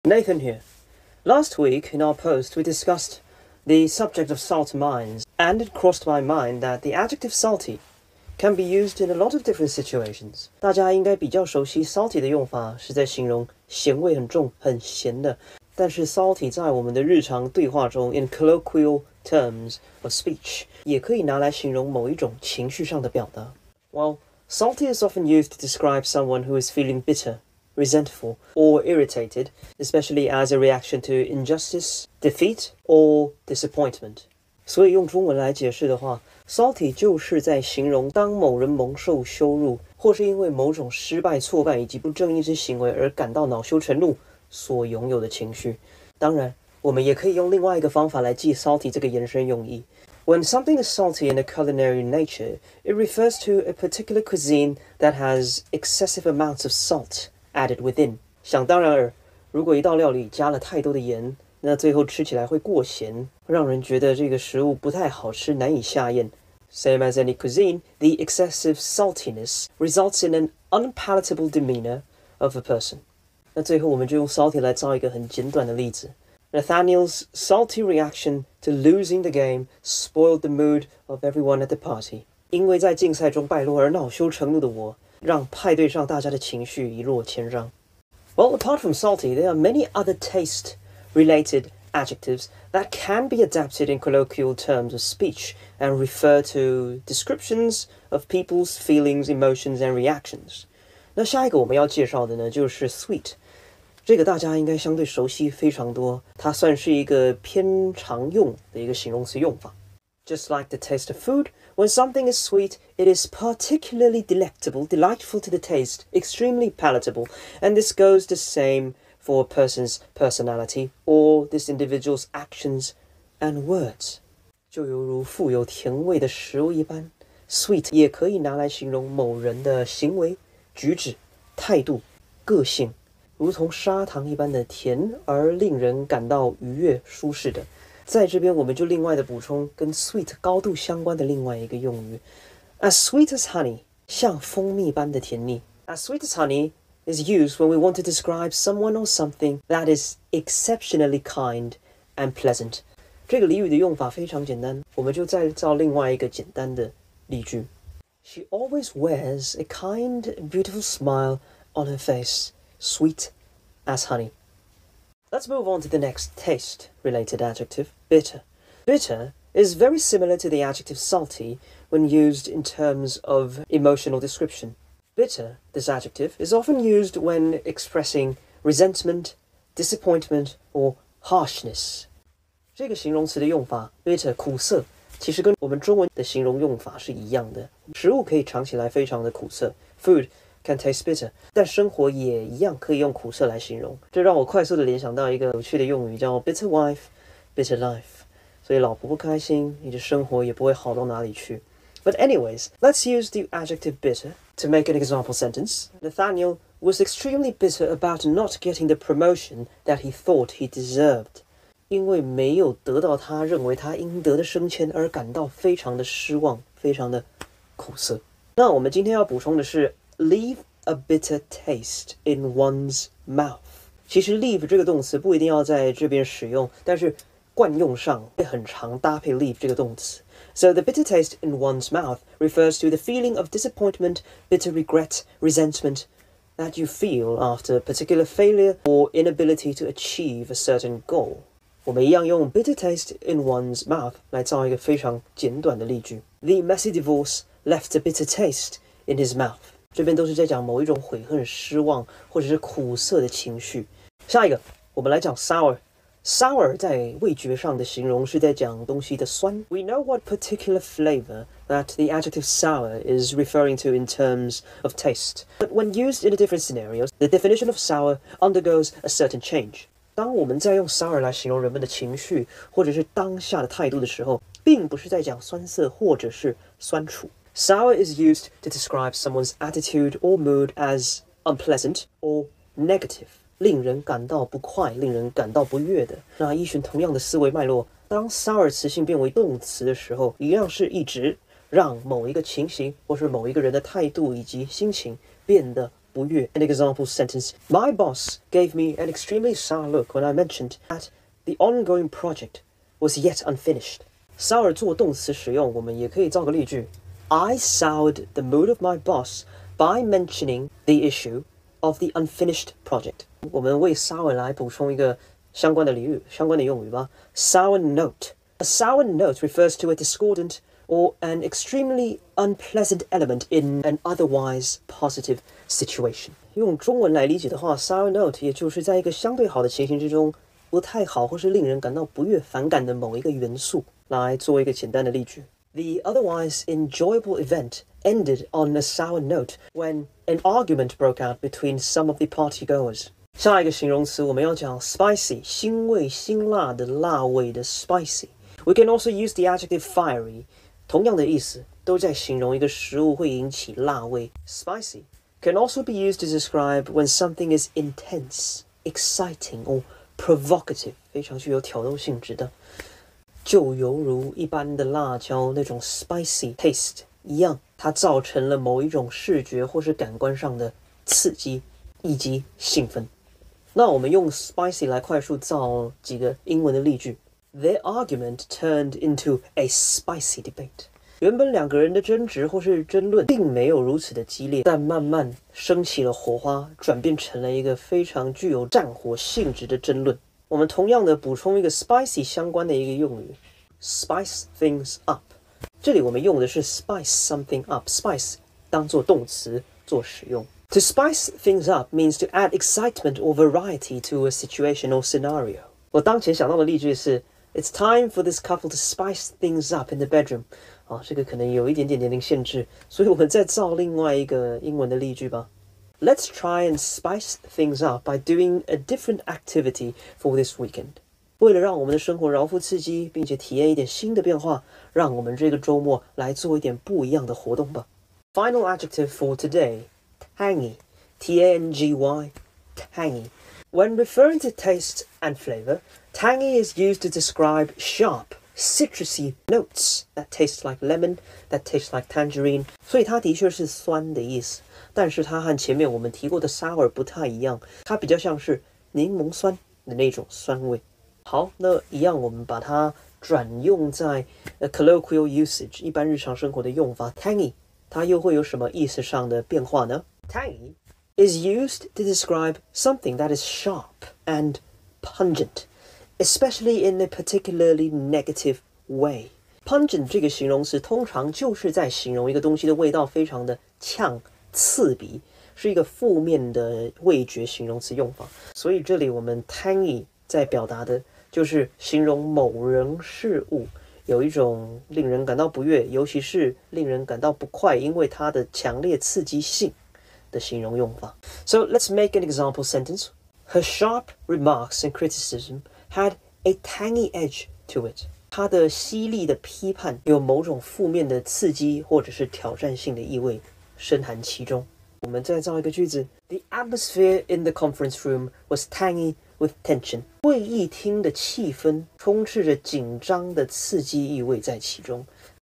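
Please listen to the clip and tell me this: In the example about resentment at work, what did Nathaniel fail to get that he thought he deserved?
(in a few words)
the promotion.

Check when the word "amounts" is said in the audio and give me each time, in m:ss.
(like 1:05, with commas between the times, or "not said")
0:56.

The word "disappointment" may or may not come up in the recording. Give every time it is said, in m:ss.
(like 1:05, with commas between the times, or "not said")
0:33, 2:59, 3:53.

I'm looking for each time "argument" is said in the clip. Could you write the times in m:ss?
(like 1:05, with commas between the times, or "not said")
5:40, 6:17.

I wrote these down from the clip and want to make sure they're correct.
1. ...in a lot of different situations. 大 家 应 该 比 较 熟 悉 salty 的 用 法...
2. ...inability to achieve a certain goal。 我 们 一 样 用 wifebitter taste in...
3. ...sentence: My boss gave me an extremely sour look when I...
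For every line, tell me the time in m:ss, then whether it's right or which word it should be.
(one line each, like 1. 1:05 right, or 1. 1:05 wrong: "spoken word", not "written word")
1. 0:08 right
2. 3:59 wrong: "bitter", not "wifebitter"
3. 4:57 right.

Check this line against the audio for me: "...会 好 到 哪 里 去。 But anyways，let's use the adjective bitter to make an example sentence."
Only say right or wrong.
right.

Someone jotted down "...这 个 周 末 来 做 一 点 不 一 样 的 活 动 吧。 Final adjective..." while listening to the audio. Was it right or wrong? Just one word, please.
right.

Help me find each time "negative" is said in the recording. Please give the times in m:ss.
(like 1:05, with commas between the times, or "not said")
4:42, 7:47.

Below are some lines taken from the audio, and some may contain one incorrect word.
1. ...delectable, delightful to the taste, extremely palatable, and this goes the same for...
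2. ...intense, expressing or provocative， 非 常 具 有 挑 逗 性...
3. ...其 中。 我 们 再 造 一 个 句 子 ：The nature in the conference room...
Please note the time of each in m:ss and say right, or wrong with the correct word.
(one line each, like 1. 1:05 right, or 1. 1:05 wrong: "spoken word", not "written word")
1. 1:54 right
2. 5:57 wrong: "exciting", not "expressing"
3. 8:24 wrong: "atmosphere", not "nature".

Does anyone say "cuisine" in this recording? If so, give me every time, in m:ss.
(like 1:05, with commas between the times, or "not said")
0:54, 1:07.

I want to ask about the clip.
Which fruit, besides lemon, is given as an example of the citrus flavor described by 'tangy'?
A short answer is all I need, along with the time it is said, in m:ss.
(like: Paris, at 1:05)
tangerine, at 7:22.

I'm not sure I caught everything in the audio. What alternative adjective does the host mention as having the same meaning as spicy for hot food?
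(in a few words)
fiery.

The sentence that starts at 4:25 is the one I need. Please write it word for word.
But when used in different scenarios, the definition of sour undergoes a certain change.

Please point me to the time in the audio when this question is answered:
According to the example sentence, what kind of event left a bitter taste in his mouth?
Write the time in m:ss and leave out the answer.
4:06.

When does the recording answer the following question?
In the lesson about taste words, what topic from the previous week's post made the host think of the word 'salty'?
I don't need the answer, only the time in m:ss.
0:04.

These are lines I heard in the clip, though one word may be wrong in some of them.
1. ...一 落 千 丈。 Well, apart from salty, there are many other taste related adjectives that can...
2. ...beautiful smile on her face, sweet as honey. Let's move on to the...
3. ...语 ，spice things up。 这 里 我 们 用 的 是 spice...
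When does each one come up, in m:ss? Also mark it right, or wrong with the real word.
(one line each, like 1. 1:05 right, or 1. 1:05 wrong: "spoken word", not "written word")
1. 1:26 right
2. 2:40 right
3. 6:33 right.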